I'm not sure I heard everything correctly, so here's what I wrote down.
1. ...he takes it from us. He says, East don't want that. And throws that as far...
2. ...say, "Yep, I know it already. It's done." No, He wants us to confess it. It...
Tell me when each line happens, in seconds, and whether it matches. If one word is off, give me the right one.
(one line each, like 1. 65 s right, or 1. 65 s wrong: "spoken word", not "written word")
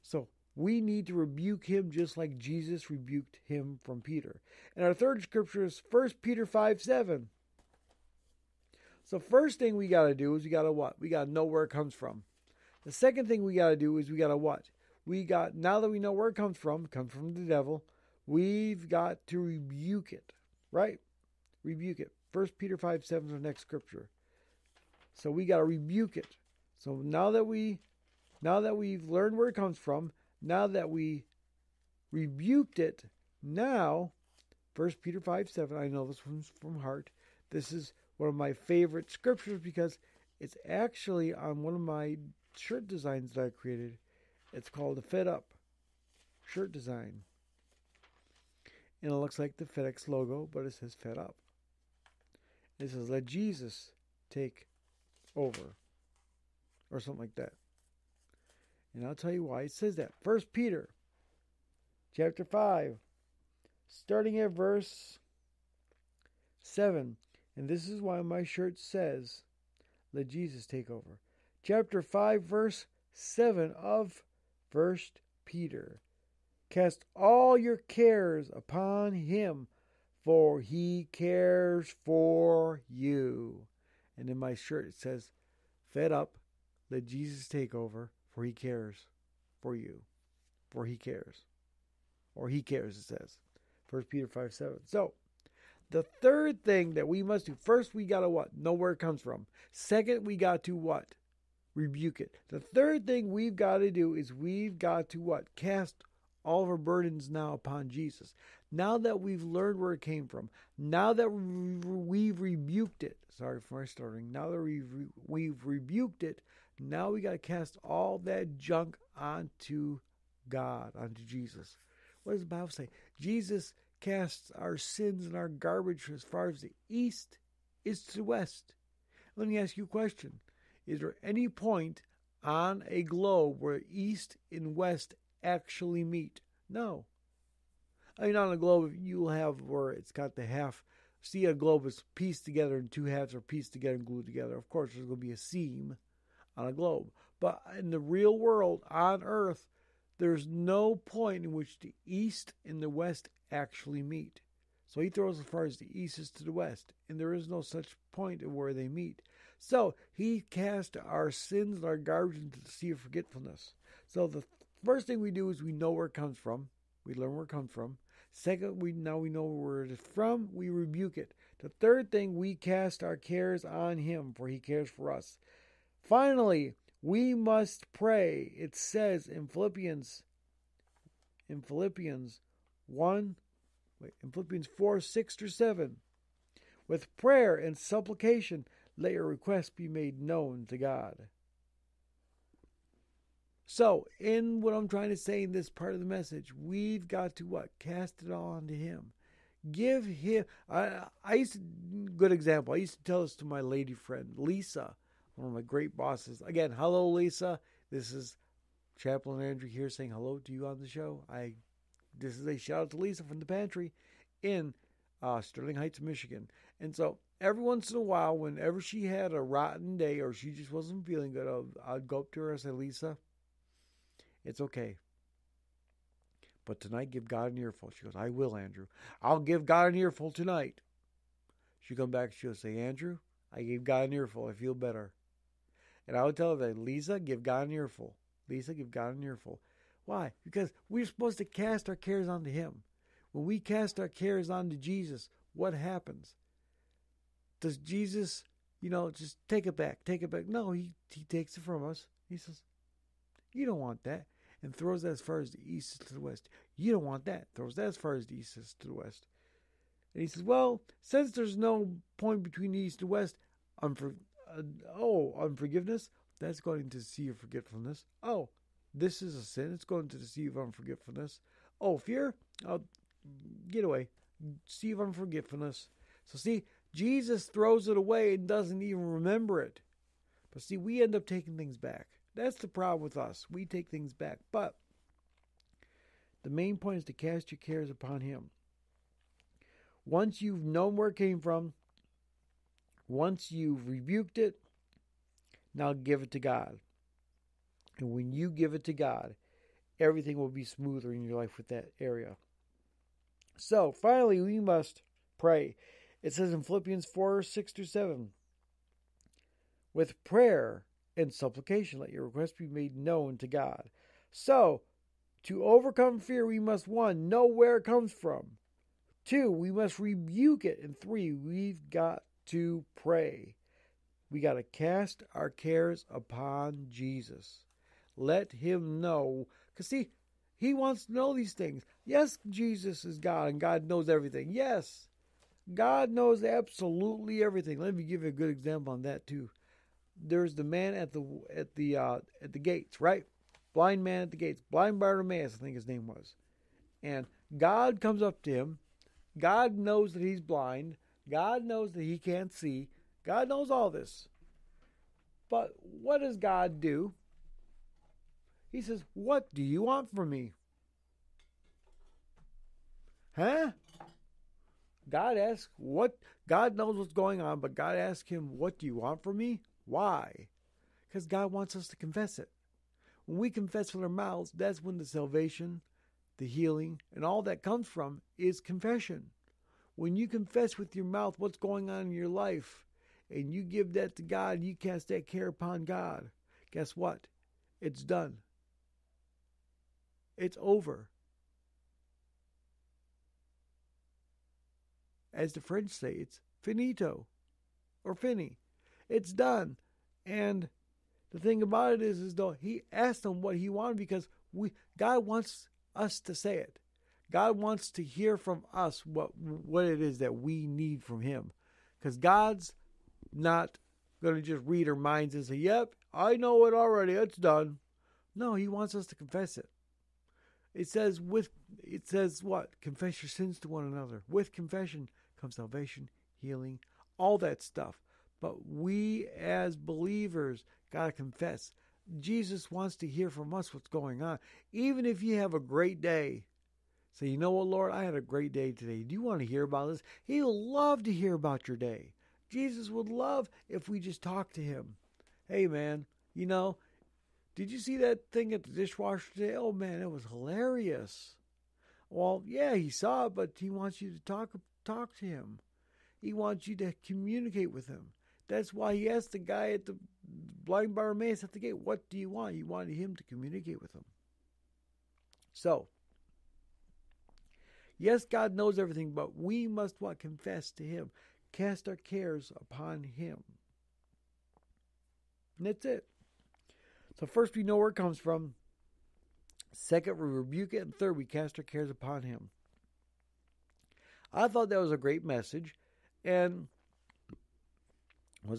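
1. 251 s wrong: "You", not "East"
2. 415 s right.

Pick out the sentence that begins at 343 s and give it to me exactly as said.
Blind man at the gates, blind Bartimaeus, I think his name was.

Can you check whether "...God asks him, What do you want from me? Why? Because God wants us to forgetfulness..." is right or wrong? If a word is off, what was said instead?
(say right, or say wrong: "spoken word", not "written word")
wrong: "confess", not "forgetfulness".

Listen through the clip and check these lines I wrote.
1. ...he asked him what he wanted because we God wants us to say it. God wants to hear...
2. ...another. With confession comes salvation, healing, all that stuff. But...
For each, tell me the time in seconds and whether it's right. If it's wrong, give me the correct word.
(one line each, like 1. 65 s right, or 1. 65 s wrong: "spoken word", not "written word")
1. 402 s right
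2. 423 s right.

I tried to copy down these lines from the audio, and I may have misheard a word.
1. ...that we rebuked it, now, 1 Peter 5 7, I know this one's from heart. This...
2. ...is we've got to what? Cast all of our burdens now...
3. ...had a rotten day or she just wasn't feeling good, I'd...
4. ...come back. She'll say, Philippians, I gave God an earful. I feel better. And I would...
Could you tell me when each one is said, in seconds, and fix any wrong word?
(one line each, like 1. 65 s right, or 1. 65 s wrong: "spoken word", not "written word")
1. 30 s right
2. 104 s right
3. 219 s right
4. 231 s wrong: "Andrew", not "Philippians".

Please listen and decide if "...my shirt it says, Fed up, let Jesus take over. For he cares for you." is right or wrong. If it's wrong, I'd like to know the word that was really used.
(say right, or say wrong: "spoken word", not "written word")
right.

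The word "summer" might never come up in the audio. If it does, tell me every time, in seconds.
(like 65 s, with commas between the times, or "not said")
not said.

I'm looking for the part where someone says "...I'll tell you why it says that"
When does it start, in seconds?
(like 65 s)
59 s.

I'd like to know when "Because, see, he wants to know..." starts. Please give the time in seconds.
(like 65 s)
329 s.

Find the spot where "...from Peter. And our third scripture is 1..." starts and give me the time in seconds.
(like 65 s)
3 s.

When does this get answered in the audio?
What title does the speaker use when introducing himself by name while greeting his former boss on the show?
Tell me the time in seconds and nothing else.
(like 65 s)
208 s.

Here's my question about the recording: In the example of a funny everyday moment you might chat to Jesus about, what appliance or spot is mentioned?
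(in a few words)
Dishwasher.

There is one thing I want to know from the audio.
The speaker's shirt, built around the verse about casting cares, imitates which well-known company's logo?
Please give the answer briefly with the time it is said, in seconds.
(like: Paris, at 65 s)
FedEx, at 49 s.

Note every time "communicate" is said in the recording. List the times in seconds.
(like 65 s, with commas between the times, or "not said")
457 s, 463 s.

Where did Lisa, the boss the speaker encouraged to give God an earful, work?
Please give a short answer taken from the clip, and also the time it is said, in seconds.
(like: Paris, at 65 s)
The pantry, at 213 s.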